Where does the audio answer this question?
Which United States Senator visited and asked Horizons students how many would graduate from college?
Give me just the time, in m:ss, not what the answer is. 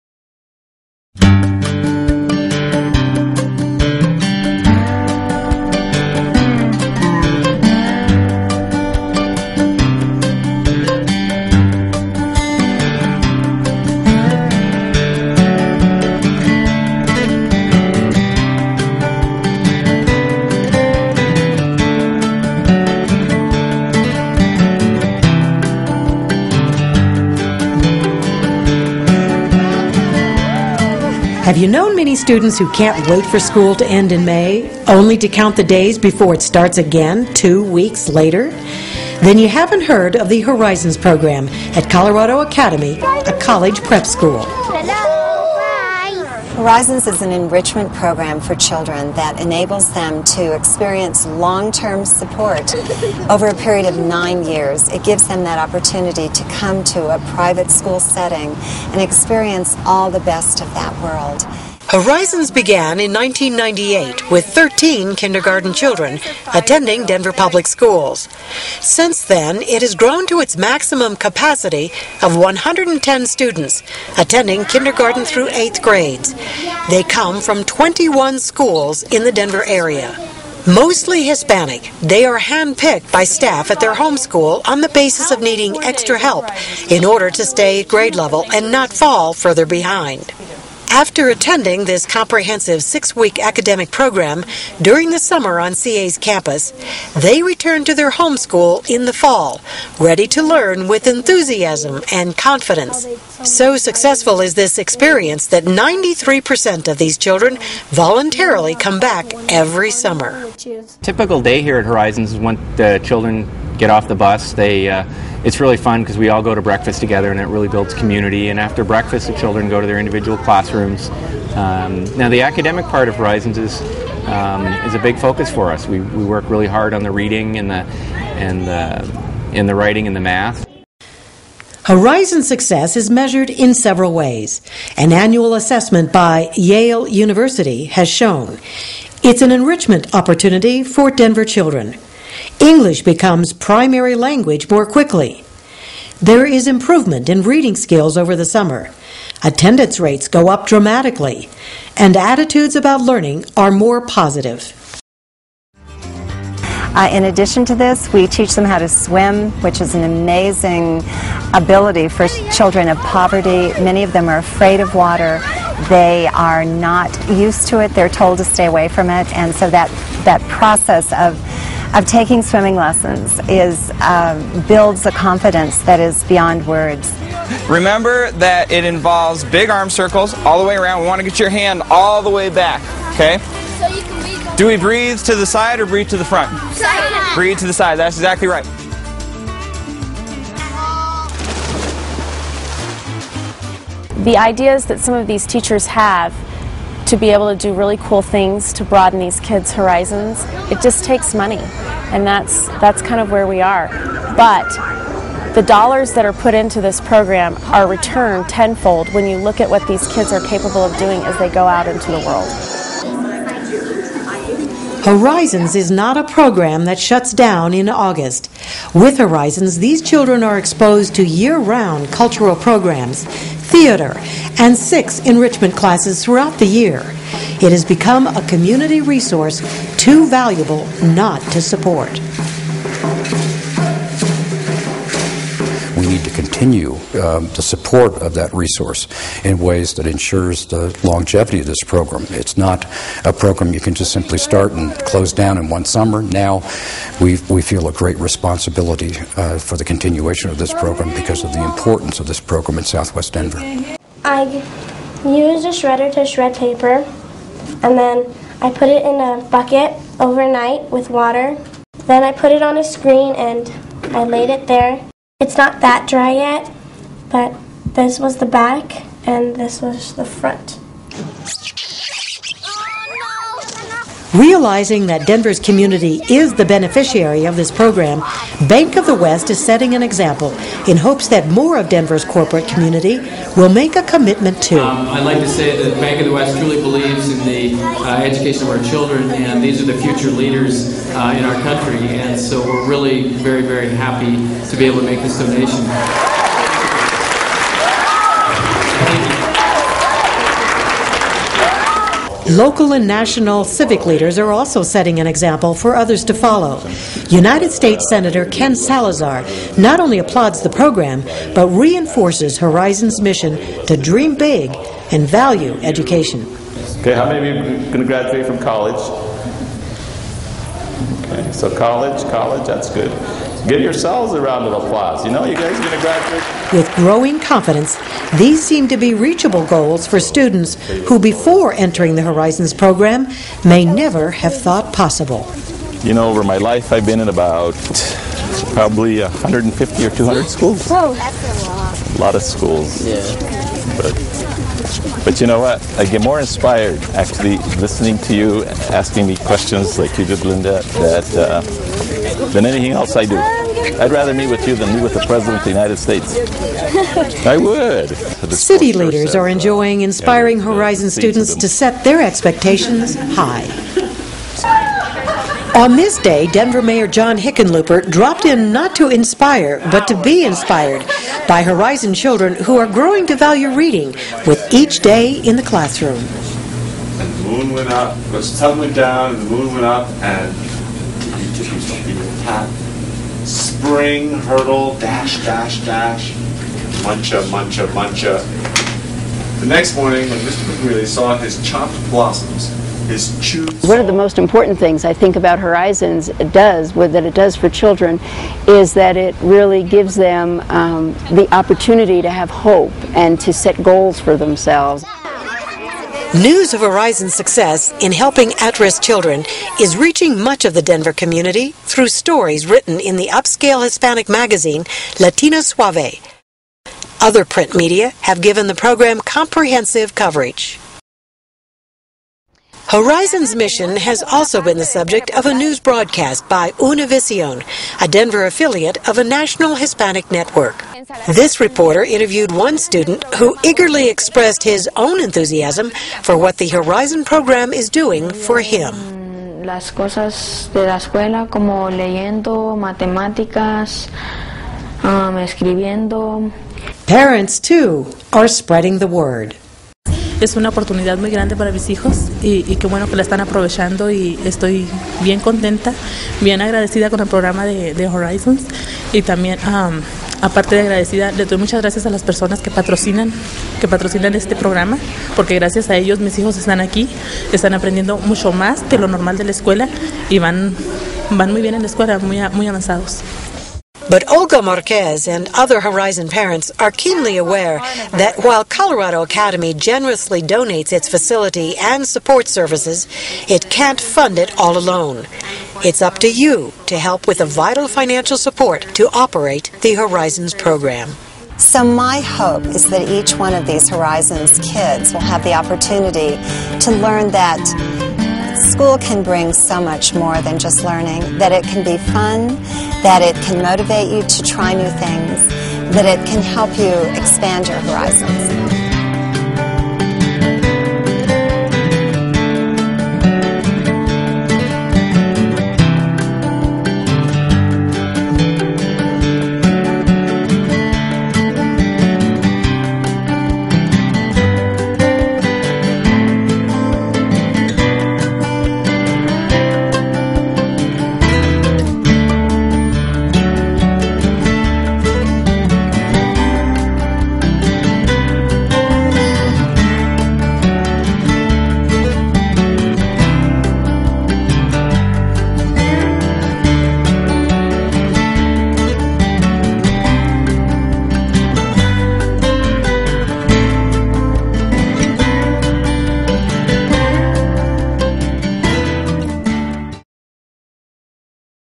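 5:08.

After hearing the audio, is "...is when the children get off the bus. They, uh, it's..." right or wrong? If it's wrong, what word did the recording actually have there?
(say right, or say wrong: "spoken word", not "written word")
right.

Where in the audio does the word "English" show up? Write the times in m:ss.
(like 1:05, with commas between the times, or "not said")
2:22.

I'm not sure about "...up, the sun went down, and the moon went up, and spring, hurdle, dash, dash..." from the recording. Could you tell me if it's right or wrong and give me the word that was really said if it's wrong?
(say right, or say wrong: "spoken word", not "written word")
right.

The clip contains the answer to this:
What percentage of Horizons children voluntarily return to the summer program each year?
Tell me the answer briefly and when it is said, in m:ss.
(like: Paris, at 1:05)
93%, at 1:45.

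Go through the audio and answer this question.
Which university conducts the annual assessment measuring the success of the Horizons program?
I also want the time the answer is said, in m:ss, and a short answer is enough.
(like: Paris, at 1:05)
Yale University, at 2:16.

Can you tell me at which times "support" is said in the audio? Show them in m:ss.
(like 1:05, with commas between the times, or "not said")
0:52, 3:51, 3:57, 8:02, 8:08.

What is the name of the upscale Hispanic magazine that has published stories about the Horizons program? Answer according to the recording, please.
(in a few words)
Latino Suave.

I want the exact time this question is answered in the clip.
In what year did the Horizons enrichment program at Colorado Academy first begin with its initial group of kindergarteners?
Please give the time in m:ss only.
1:03.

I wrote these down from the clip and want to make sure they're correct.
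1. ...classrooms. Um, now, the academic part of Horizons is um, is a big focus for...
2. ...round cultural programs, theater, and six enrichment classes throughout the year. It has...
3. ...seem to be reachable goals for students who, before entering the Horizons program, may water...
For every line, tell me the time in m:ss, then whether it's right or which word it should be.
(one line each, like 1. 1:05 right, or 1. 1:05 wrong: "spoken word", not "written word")
1. 2:00 right
2. 3:41 right
3. 5:28 wrong: "never", not "water".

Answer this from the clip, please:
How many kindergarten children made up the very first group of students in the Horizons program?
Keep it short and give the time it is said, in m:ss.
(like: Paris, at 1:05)
13, at 1:04.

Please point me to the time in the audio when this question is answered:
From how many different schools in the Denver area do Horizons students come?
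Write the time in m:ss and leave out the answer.
1:17.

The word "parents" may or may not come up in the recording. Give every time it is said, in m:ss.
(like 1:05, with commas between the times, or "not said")
7:27, 7:56.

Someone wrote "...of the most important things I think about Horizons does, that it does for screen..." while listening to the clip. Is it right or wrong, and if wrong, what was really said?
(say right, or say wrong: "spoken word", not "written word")
wrong: "children", not "screen".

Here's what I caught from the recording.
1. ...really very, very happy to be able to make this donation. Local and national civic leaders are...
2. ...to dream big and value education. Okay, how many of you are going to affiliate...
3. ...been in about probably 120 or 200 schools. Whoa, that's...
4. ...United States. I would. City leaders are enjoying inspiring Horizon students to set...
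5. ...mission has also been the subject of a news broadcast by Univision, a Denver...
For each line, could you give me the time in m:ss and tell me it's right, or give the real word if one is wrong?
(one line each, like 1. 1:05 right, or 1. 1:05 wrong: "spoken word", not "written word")
1. 4:52 right
2. 5:13 wrong: "graduate", not "affiliate"
3. 5:37 wrong: "150", not "120"
4. 5:55 right
5. 7:03 right.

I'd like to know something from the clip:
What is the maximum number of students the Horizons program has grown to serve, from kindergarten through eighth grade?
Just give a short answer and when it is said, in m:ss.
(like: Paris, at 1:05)
110, at 1:12.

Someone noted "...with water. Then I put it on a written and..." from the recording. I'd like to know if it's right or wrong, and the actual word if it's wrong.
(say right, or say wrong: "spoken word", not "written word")
wrong: "screen", not "written".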